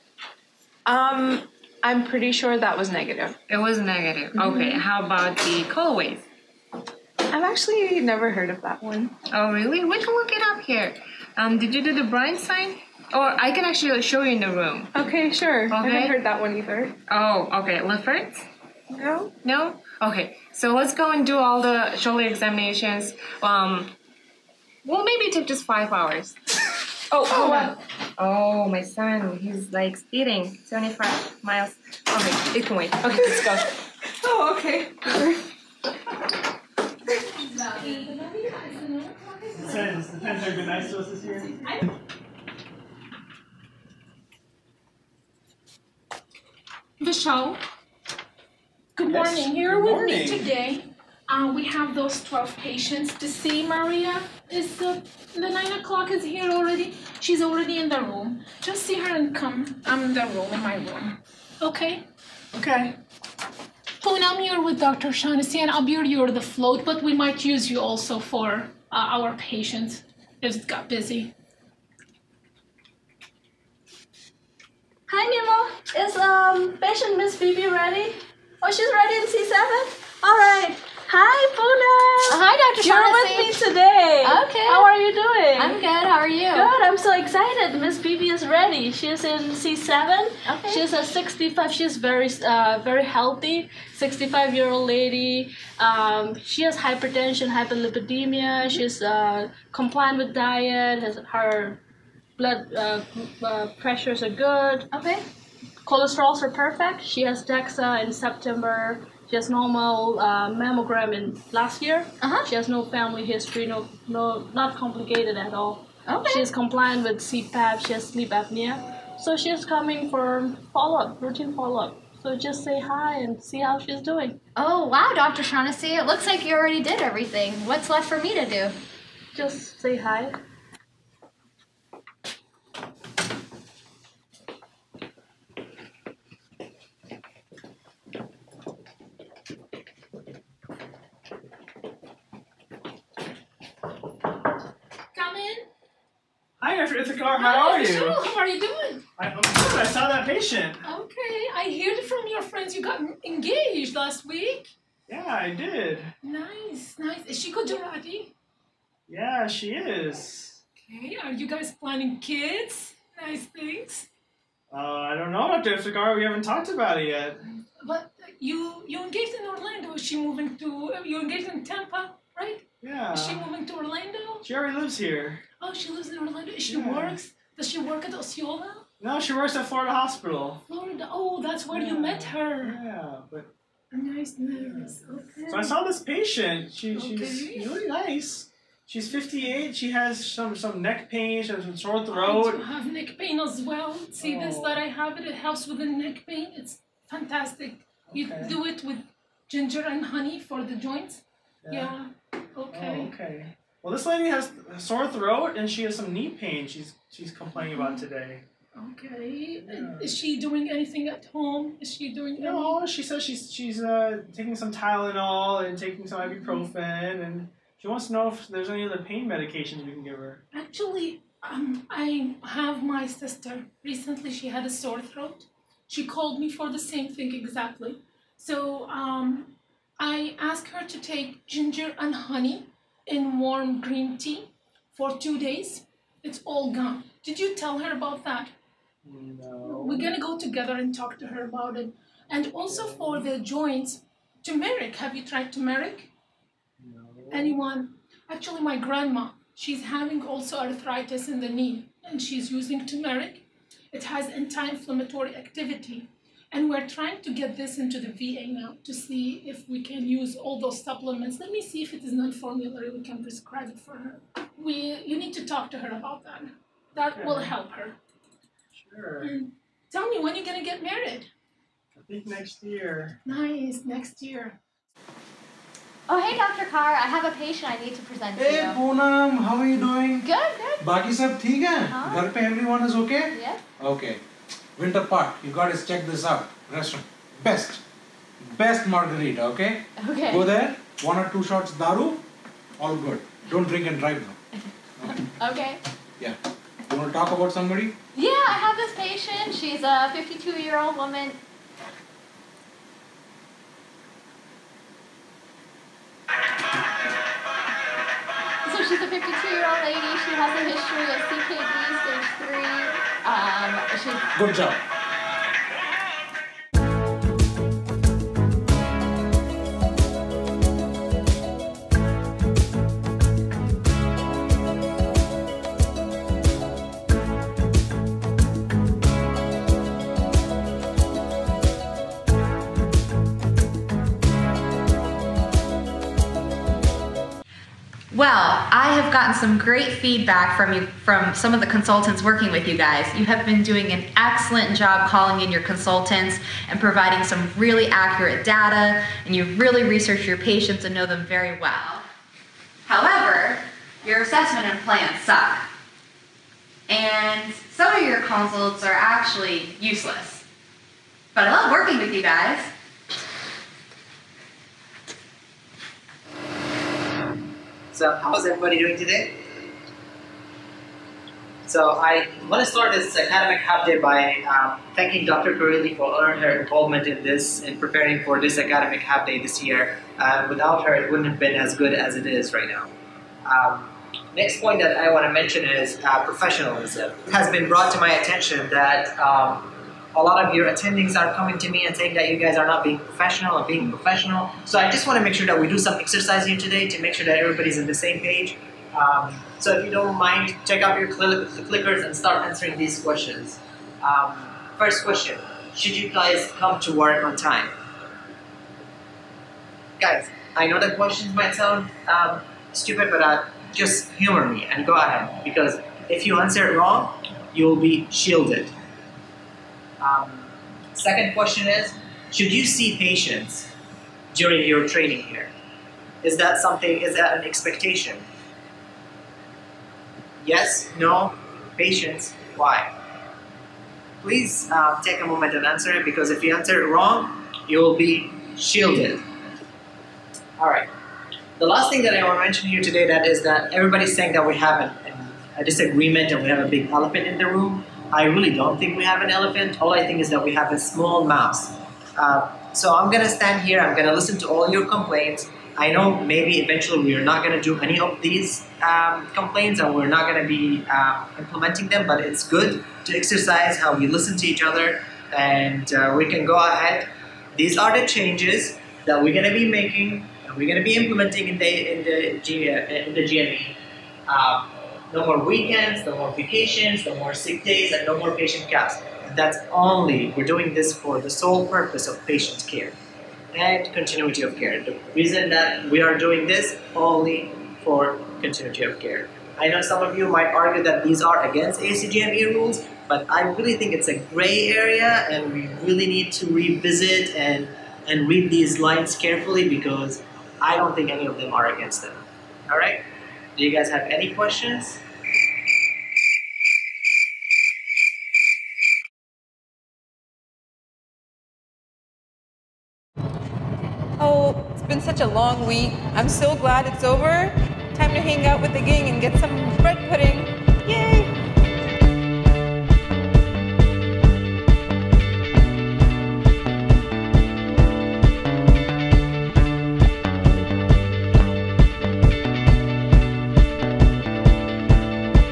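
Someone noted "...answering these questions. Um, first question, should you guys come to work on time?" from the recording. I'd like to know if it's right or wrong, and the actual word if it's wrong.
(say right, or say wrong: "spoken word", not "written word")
right.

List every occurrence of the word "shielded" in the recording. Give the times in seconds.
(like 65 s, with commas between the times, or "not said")
418 s, 438 s.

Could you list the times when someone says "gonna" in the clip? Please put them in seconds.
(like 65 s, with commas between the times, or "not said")
239 s.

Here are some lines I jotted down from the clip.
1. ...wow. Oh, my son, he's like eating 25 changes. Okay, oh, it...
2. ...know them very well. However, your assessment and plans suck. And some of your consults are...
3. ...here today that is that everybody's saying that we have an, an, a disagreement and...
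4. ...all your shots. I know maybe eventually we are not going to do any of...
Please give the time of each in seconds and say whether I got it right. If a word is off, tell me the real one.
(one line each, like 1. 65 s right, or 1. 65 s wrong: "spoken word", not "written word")
1. 27 s wrong: "miles", not "changes"
2. 350 s right
3. 442 s right
4. 454 s wrong: "complaints", not "shots".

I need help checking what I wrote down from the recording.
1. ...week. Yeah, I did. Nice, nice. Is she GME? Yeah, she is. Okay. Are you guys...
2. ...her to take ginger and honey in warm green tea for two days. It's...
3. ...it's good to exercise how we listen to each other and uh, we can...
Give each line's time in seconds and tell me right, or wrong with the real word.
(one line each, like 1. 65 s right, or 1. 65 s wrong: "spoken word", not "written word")
1. 154 s wrong: "Gujarati", not "GME"
2. 230 s right
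3. 462 s right.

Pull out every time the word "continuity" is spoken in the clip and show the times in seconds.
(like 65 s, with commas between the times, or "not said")
483 s, 488 s.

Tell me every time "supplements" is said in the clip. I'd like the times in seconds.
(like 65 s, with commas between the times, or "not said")
260 s.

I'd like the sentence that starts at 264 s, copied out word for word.
We, you need to talk to her about that.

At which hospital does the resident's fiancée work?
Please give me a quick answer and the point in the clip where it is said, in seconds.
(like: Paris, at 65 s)
Florida Hospital, at 179 s.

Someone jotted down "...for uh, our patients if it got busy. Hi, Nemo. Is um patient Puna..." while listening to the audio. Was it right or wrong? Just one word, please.
wrong.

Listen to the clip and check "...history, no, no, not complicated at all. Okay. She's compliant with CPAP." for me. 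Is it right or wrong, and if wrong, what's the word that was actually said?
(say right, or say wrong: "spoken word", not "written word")
right.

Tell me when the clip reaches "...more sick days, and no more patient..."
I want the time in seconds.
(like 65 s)
477 s.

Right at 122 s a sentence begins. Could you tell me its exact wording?
So just say hi and see how she's doing.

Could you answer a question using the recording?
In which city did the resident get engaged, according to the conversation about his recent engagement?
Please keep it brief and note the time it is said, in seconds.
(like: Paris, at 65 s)
Tampa, at 171 s.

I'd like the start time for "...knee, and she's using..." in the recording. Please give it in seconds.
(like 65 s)
251 s.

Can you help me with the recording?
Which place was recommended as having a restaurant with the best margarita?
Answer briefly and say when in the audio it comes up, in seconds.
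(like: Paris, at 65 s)
Winter Park, at 284 s.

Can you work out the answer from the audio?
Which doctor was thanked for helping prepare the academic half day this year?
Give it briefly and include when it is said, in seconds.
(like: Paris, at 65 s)
Dr. Corelli, at 375 s.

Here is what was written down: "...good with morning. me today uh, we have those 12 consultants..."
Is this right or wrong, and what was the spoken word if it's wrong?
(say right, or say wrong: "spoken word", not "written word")
wrong: "patients", not "consultants".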